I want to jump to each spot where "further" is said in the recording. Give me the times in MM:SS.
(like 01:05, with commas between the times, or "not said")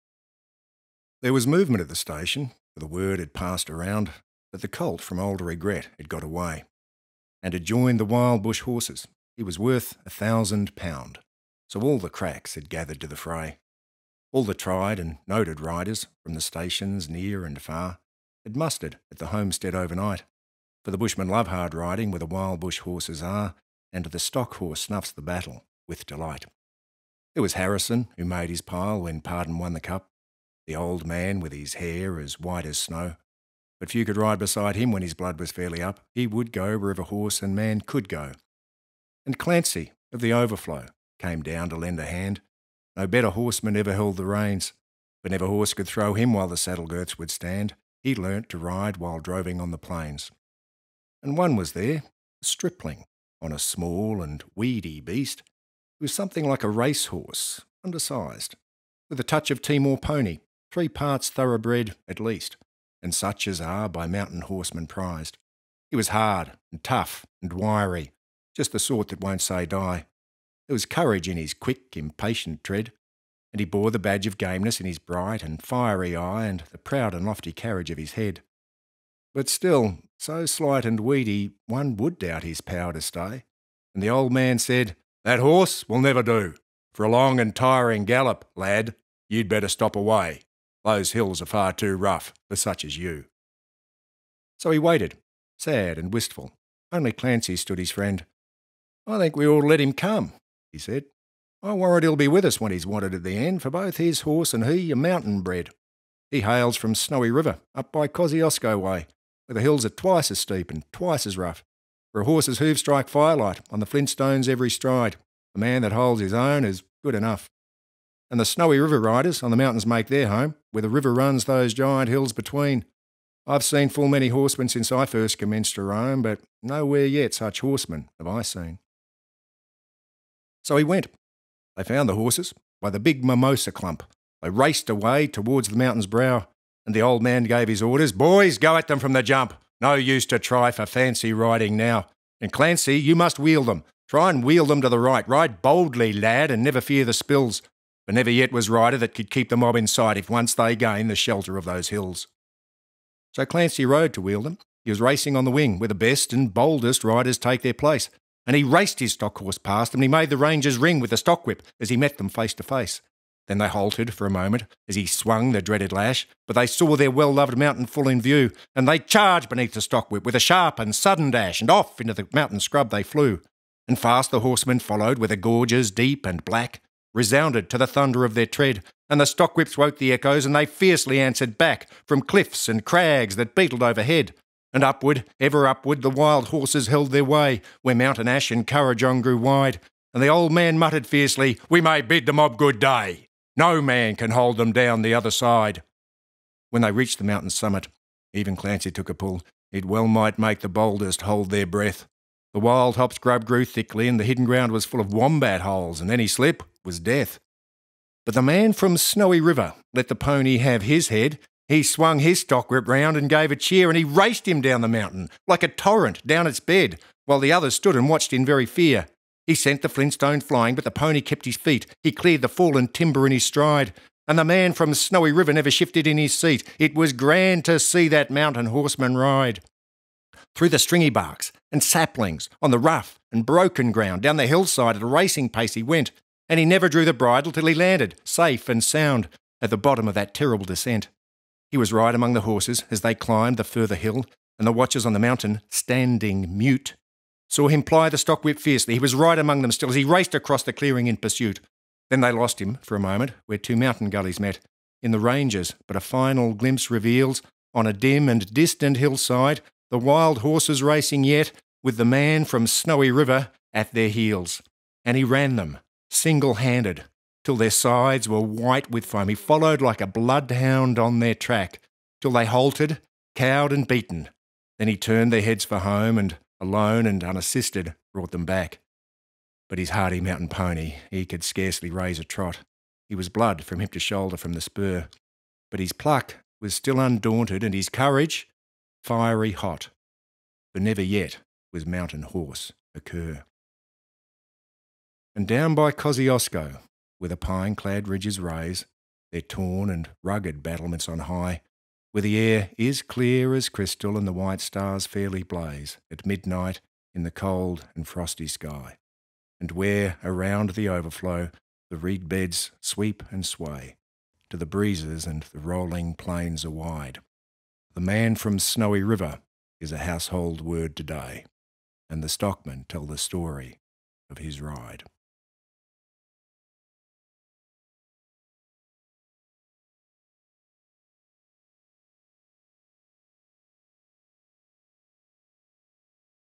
04:03.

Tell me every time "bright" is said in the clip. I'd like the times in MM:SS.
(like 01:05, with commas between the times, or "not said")
01:14.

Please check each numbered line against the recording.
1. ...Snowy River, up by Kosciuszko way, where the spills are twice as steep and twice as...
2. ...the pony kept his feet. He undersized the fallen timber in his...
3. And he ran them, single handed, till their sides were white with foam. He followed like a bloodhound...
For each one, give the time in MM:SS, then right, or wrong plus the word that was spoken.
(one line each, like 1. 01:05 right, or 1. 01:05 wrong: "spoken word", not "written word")
1. 01:46 wrong: "hills", not "spills"
2. 03:40 wrong: "cleared", not "undersized"
3. 04:25 right.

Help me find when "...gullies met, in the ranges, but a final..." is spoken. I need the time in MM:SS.
04:14.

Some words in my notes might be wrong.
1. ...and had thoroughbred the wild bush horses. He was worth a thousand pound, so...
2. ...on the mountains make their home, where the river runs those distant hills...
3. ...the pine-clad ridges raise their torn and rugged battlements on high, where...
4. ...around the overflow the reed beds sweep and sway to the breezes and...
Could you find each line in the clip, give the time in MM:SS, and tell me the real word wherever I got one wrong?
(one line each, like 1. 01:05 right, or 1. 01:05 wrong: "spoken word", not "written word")
1. 00:07 wrong: "joined", not "thoroughbred"
2. 01:59 wrong: "giant", not "distant"
3. 04:57 right
4. 05:10 right.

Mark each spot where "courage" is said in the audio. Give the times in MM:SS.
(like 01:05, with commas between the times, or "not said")
01:10, 04:47.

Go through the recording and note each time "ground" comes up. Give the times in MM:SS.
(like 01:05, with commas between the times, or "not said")
03:24, 03:53.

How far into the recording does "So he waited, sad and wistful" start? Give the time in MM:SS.
01:34.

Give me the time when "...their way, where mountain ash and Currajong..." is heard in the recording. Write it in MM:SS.
03:07.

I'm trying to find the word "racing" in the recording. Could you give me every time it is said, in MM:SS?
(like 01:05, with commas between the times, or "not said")
02:35, 03:55, 04:20.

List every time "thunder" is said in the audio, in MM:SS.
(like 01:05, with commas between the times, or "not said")
02:57.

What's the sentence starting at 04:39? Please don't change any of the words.
But his hardy mountain pony, he could scarcely raise a trot.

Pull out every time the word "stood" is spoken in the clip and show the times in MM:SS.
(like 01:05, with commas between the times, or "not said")
01:37, 03:37.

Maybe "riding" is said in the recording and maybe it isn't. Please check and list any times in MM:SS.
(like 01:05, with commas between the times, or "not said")
00:21, 02:21.